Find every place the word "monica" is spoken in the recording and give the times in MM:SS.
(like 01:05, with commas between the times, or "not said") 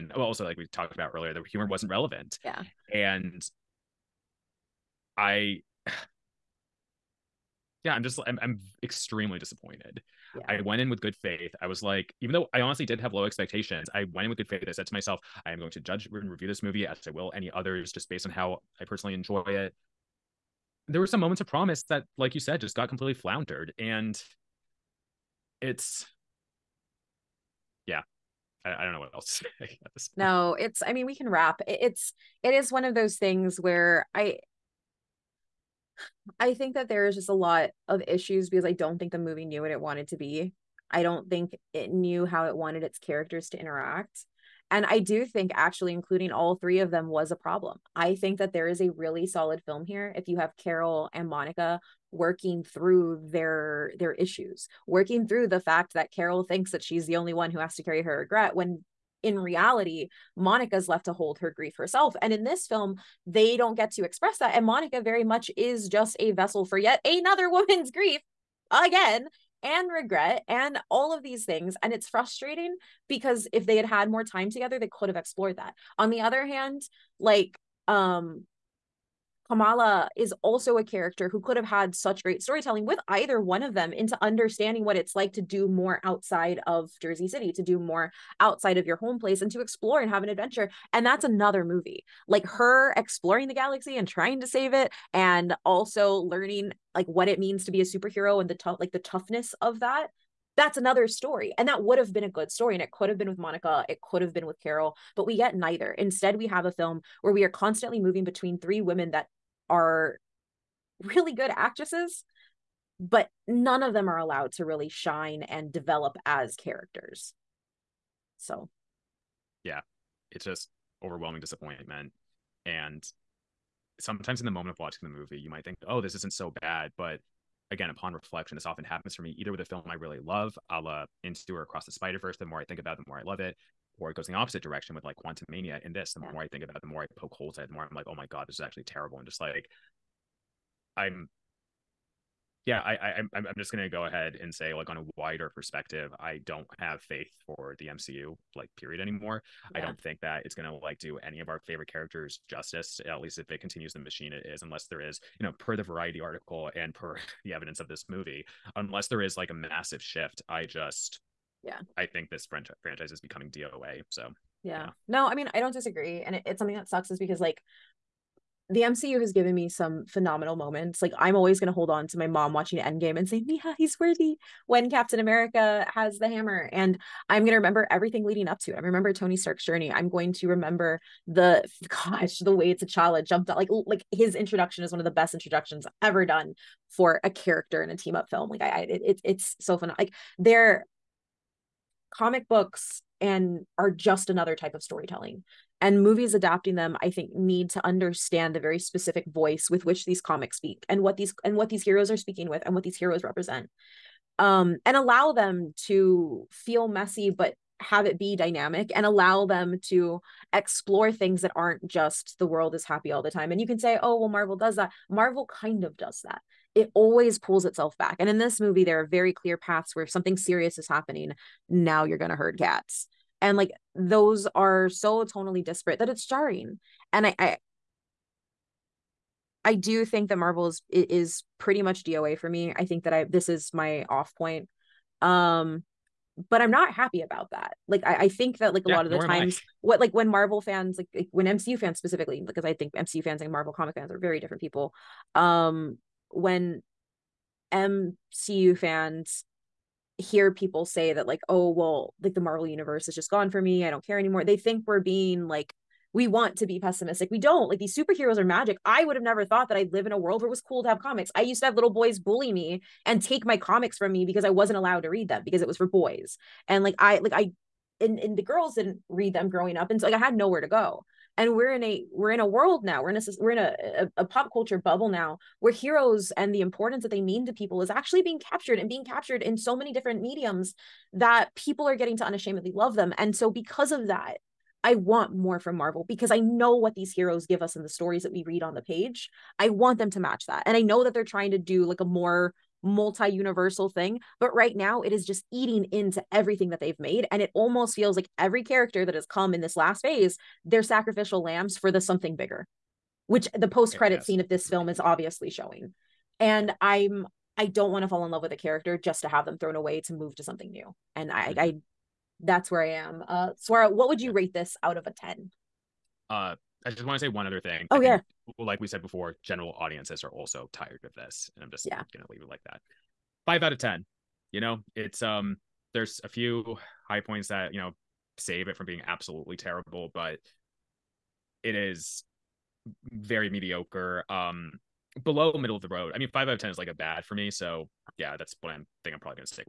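00:51, 01:00, 01:04, 01:43.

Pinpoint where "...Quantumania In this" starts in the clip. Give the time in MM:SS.
02:15.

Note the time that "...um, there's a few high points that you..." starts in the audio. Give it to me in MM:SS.
05:25.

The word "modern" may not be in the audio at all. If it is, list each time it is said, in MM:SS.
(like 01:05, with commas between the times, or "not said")
not said.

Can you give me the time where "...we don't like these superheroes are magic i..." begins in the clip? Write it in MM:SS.
04:17.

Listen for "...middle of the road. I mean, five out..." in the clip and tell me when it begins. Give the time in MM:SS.
05:35.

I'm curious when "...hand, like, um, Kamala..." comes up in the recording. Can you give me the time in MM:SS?
01:16.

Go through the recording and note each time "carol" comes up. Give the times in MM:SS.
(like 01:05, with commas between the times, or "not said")
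00:50, 00:56, 01:44.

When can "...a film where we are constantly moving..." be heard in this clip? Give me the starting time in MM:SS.
01:46.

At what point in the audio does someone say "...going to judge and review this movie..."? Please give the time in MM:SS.
00:15.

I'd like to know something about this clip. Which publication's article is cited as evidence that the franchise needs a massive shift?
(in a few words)
Variety.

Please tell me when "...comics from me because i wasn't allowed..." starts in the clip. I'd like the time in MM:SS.
04:23.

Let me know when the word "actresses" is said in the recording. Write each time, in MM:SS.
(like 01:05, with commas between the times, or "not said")
01:51.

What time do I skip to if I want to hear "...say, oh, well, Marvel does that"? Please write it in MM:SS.
03:33.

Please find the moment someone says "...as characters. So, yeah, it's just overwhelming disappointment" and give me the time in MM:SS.
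01:56.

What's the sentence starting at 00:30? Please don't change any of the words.
No, it's, I mean, we can wrap.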